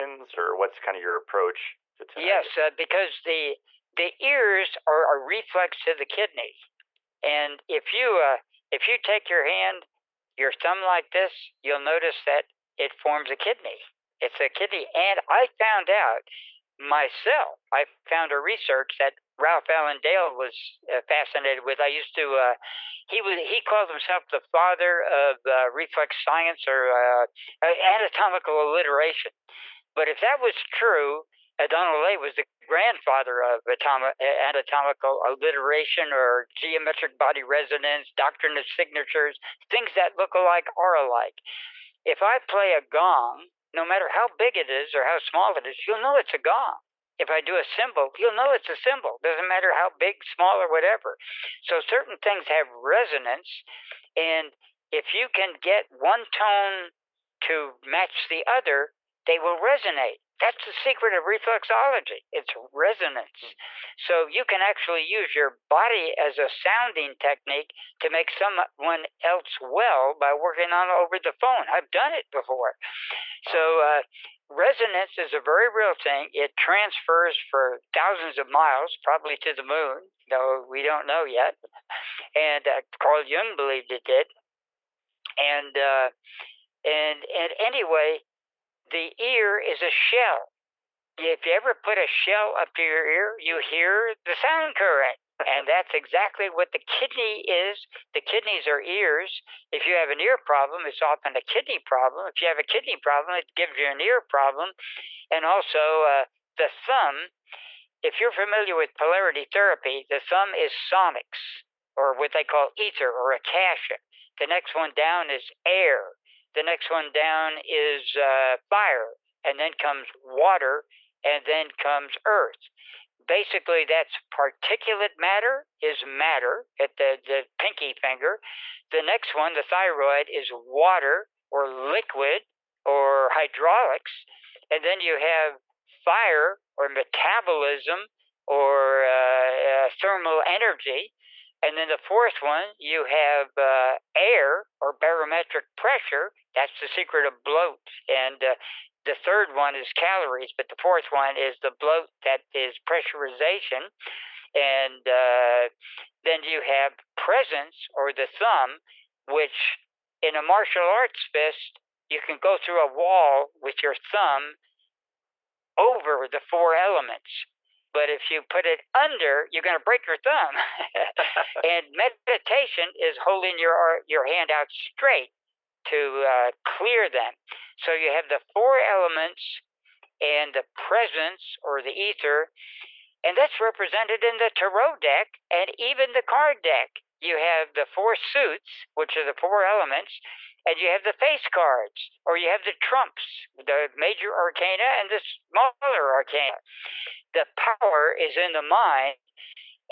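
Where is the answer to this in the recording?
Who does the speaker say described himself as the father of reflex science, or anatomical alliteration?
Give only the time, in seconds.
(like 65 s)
19 s.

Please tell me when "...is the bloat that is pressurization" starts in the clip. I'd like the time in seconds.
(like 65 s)
151 s.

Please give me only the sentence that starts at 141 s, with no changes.
And then the fourth one, you have uh, air or barometric pressure.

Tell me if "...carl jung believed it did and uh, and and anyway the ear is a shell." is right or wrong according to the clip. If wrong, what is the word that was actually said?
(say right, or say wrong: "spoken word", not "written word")
right.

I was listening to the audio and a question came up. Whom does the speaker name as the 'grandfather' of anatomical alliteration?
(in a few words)
O'Donnell.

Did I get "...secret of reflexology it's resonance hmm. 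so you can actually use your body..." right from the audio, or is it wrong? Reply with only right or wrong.
right.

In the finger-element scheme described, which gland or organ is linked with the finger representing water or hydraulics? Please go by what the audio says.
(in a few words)
thyroid.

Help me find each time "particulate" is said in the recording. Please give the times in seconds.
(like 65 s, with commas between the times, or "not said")
124 s.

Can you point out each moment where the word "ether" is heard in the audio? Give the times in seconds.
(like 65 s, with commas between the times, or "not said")
112 s, 181 s.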